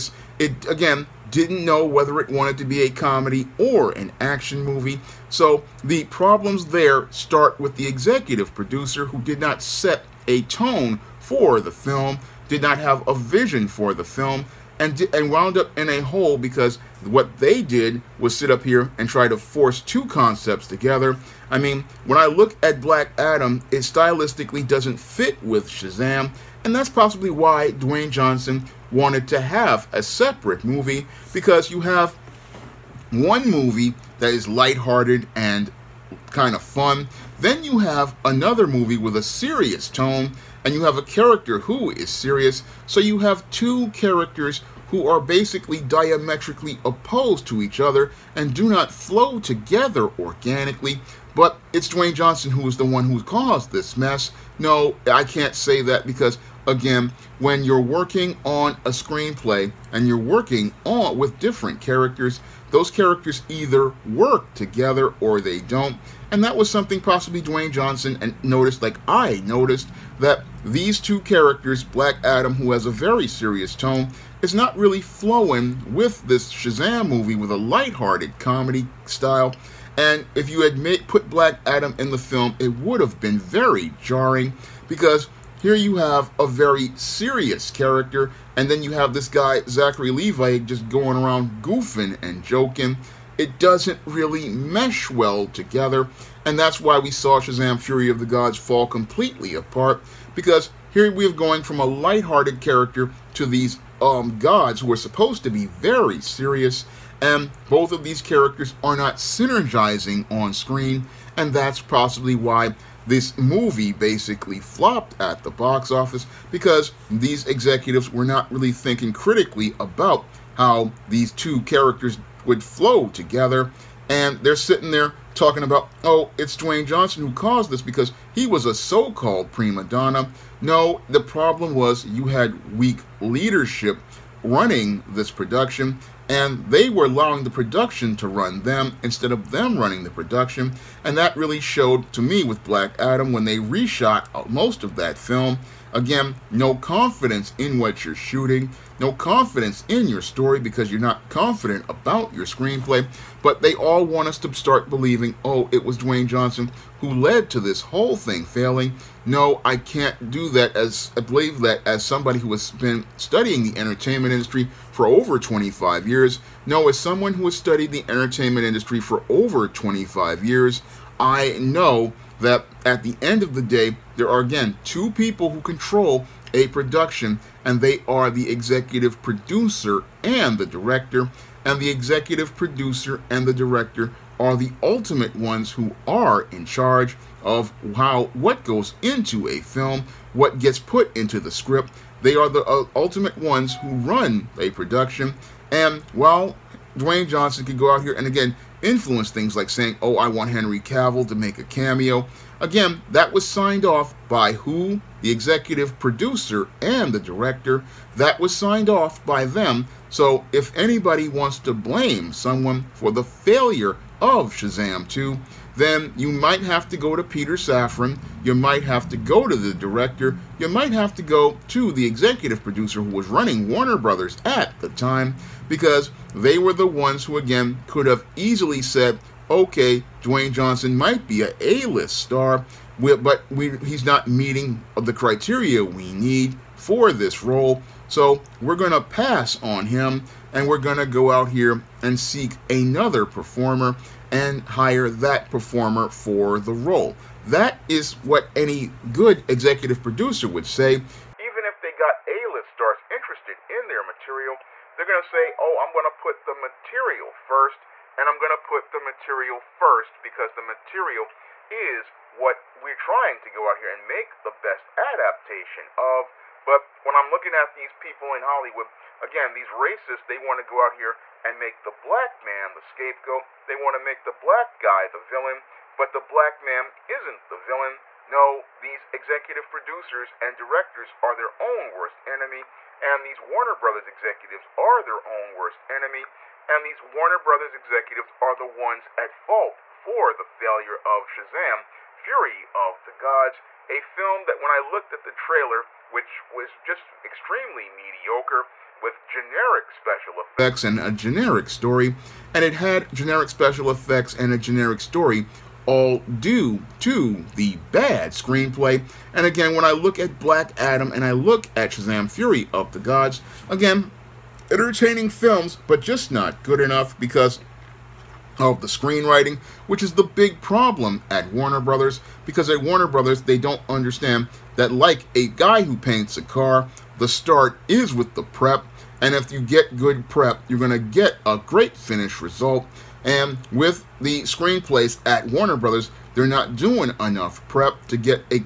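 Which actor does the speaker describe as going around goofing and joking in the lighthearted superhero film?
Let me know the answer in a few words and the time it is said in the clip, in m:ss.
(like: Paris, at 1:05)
Zachary Levi, at 1:29.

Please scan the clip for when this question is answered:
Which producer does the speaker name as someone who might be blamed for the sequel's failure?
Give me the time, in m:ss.
3:37.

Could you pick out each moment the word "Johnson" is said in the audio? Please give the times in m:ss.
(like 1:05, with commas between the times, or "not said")
0:28, 0:52, 1:07, 2:06, 2:36, 3:17, 3:50.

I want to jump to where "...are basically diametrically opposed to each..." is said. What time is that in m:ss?
0:45.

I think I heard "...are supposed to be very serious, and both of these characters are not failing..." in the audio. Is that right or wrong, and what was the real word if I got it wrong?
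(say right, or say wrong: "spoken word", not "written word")
wrong: "synergizing", not "failing".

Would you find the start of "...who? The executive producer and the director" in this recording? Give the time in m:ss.
3:24.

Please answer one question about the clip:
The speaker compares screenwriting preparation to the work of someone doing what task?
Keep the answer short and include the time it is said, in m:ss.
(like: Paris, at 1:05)
paints a car, at 5:25.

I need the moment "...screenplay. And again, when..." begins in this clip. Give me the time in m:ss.
5:08.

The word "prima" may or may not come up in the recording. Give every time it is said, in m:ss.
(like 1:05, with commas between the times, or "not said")
2:09.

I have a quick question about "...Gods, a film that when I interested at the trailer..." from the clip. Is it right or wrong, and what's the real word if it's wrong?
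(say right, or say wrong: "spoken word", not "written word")
wrong: "looked", not "interested".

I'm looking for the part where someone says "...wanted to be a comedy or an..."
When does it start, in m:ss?
0:02.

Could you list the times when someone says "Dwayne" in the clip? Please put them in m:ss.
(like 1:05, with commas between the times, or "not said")
0:27, 0:51, 1:07, 2:06, 2:35, 3:16, 3:50.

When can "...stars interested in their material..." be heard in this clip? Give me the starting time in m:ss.
4:12.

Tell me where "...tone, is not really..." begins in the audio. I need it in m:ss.
1:13.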